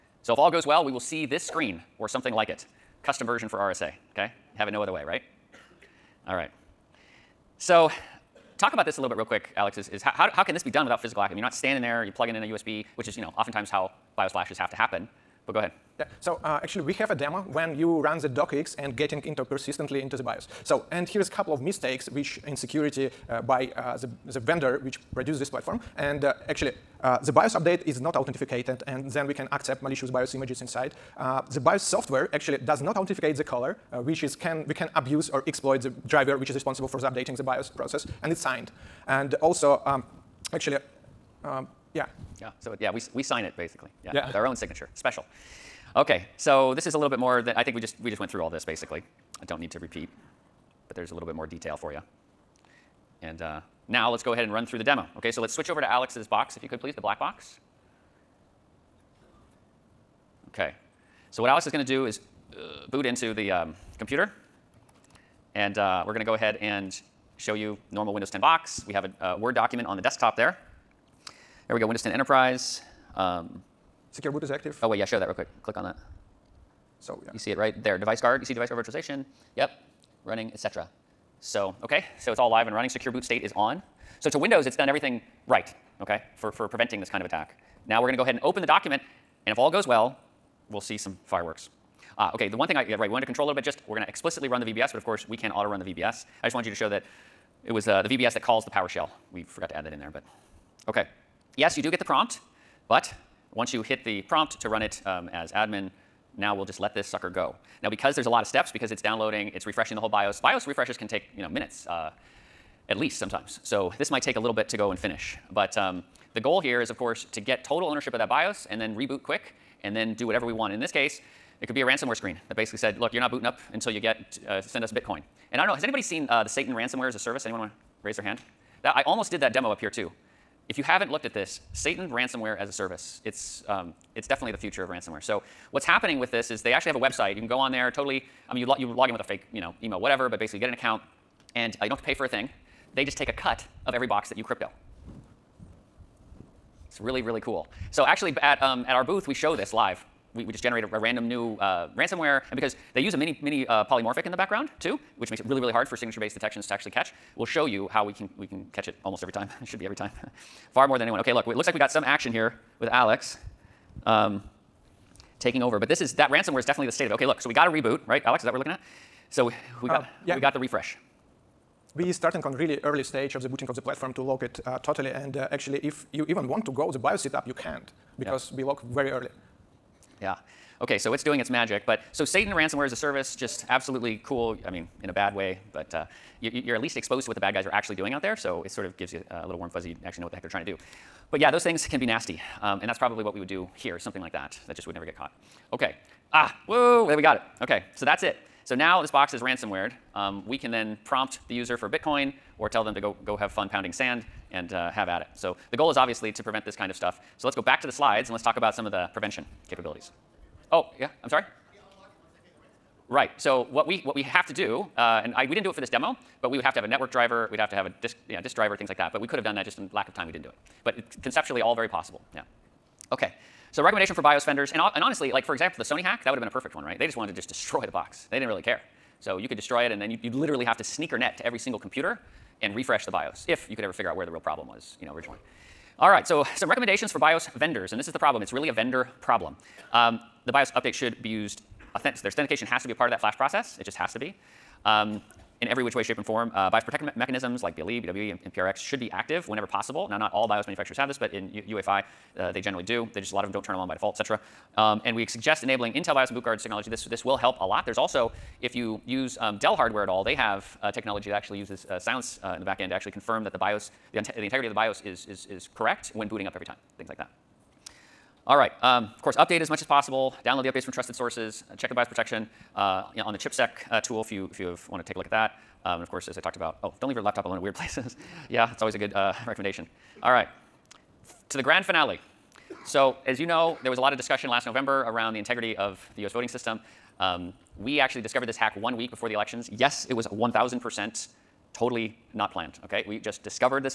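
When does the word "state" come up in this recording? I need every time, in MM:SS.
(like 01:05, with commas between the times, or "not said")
01:23, 02:46.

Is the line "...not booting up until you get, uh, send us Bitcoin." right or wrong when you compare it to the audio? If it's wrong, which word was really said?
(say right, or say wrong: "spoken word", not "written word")
right.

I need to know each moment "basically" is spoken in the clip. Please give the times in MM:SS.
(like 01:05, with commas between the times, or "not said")
00:43, 00:48, 02:02, 02:20.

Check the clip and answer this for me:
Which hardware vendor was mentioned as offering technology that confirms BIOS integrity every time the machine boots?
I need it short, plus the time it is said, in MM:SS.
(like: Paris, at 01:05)
Dell, at 04:19.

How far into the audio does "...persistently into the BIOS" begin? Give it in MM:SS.
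00:19.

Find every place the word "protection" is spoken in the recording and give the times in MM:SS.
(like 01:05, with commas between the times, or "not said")
04:06, 04:32.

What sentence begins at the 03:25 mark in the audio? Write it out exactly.
So the goal is obviously to prevent this kind of stuff.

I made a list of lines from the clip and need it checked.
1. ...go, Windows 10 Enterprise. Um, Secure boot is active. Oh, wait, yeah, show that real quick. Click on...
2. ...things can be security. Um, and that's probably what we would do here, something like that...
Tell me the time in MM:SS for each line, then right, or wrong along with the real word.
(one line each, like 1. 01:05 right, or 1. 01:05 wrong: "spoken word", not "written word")
1. 01:11 right
2. 03:11 wrong: "nasty", not "security".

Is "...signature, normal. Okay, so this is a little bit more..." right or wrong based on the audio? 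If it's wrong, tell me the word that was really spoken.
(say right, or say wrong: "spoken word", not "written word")
wrong: "special", not "normal".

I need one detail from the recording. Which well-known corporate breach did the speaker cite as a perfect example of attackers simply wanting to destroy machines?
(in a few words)
Sony hack.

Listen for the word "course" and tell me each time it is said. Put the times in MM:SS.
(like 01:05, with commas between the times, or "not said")
01:35, 01:56, 04:29, 04:36.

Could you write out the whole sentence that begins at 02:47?
Okay, look, so we got a reboot, right?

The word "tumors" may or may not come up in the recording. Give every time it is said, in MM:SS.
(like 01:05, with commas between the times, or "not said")
not said.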